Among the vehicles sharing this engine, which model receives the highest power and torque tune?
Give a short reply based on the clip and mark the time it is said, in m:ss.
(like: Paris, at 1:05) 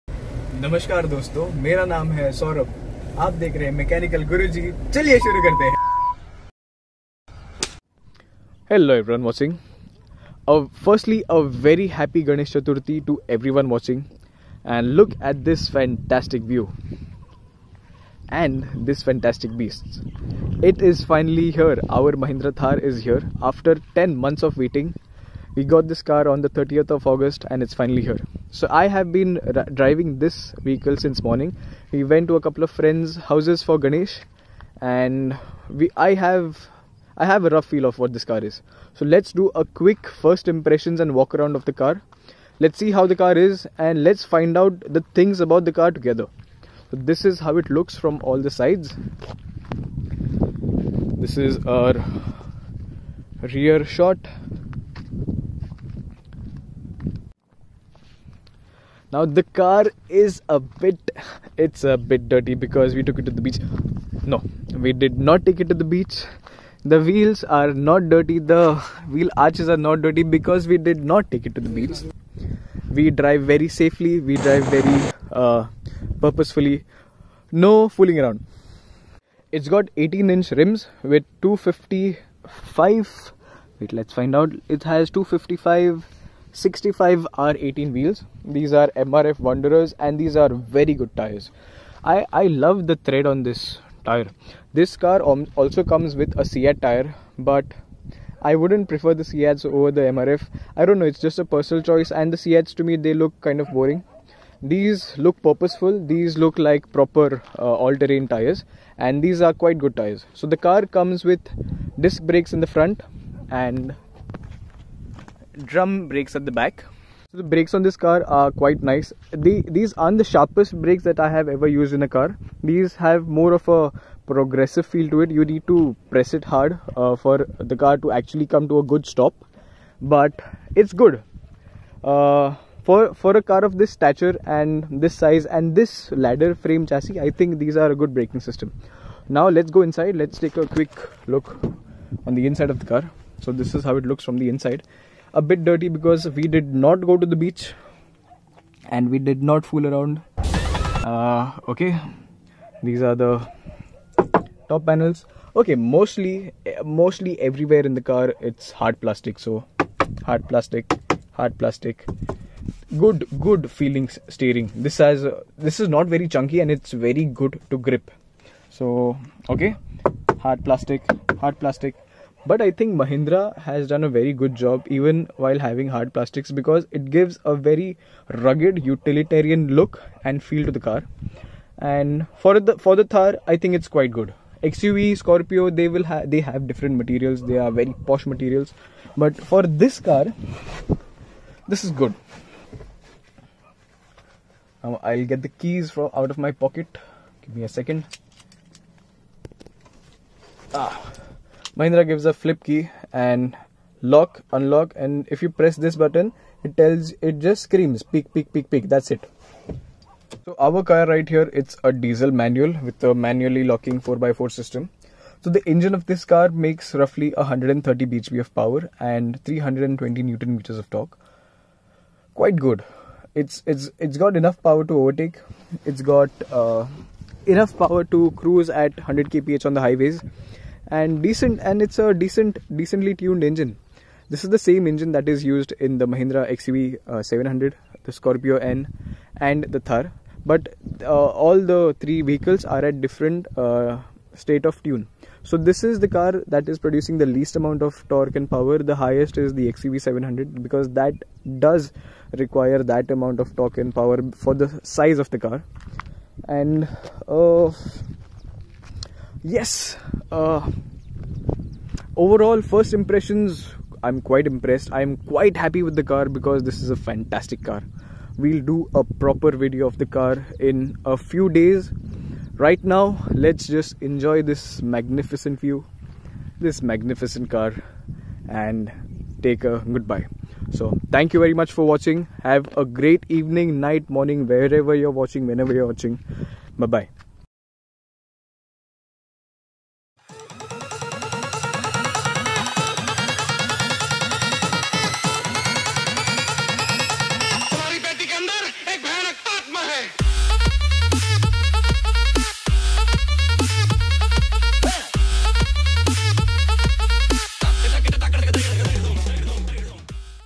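XUV 700, at 4:09.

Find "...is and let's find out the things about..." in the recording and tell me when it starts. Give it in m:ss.
0:43.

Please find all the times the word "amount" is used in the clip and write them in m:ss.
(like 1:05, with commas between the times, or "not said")
4:07, 4:13.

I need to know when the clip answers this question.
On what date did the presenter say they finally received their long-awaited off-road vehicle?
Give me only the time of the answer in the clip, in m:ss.
0:26.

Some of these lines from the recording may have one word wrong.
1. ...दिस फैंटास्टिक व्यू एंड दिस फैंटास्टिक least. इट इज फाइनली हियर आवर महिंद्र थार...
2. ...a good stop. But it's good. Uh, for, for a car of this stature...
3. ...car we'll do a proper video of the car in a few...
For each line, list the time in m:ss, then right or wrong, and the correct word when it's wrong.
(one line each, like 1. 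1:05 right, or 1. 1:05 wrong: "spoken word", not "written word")
1. 0:15 wrong: "beast", not "least"
2. 2:08 right
3. 4:27 right.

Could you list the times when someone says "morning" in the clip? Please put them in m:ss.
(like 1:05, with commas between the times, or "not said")
0:31, 4:44.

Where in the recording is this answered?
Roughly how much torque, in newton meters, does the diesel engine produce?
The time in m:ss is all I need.
3:39.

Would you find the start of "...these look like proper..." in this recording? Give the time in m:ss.
1:46.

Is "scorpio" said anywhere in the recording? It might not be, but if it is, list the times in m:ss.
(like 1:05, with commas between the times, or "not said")
3:05, 3:58.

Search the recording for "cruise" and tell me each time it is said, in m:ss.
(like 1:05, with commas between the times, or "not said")
3:48.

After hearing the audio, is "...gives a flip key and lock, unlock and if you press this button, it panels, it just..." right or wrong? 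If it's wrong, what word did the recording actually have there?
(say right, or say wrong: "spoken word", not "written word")
wrong: "tells", not "panels".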